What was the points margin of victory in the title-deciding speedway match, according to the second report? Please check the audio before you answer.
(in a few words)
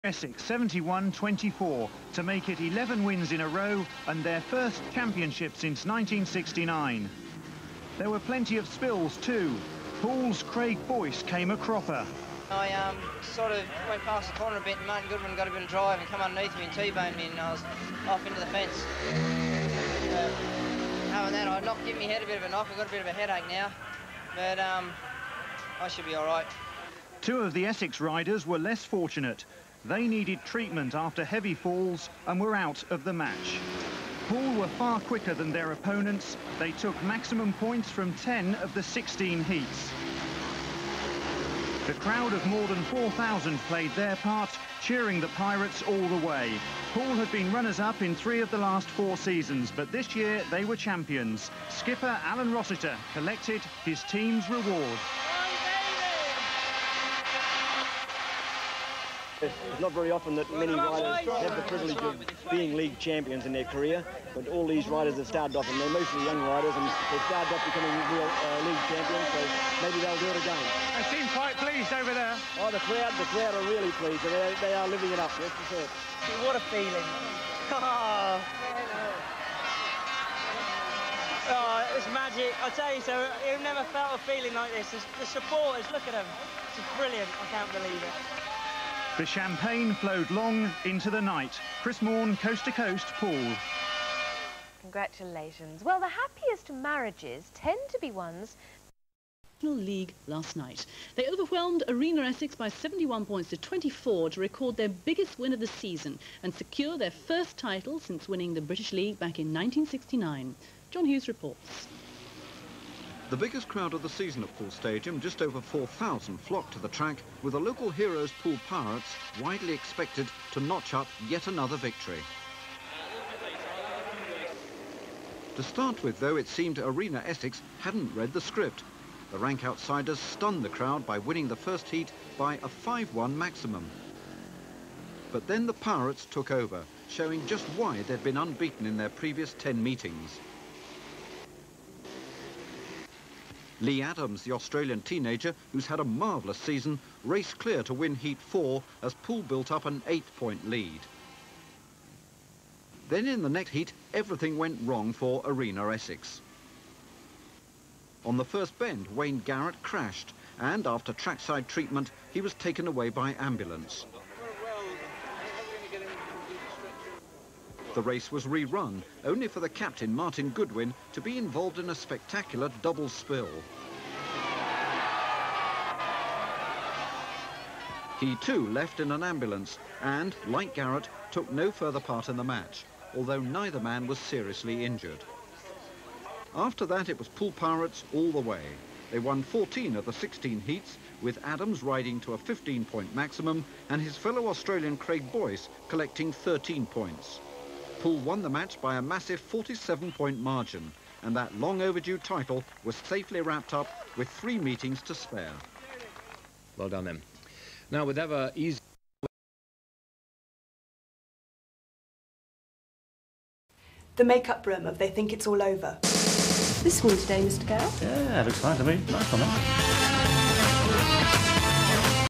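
47.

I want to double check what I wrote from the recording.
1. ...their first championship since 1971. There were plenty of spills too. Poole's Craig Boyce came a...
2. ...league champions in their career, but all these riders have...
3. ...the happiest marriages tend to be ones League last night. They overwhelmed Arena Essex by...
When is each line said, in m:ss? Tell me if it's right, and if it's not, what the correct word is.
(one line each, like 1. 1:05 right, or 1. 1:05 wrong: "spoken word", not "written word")
1. 0:04 wrong: "1969", not "1971"
2. 1:02 right
3. 1:35 right.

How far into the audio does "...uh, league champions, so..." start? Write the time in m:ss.
1:08.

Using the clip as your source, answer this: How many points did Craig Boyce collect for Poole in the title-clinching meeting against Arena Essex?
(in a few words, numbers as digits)
13.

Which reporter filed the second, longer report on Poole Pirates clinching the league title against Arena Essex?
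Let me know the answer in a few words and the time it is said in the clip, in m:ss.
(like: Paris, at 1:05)
John Hughes, at 1:50.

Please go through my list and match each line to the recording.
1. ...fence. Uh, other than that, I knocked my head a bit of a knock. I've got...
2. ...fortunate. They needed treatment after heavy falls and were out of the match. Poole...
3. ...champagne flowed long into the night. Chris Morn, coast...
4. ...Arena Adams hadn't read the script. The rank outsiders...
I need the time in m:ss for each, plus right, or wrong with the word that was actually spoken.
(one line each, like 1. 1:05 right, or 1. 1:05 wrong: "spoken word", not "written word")
1. 0:18 right
2. 0:28 right
3. 1:29 right
4. 2:06 wrong: "Essex", not "Adams".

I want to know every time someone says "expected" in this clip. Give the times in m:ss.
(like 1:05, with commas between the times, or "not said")
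1:59.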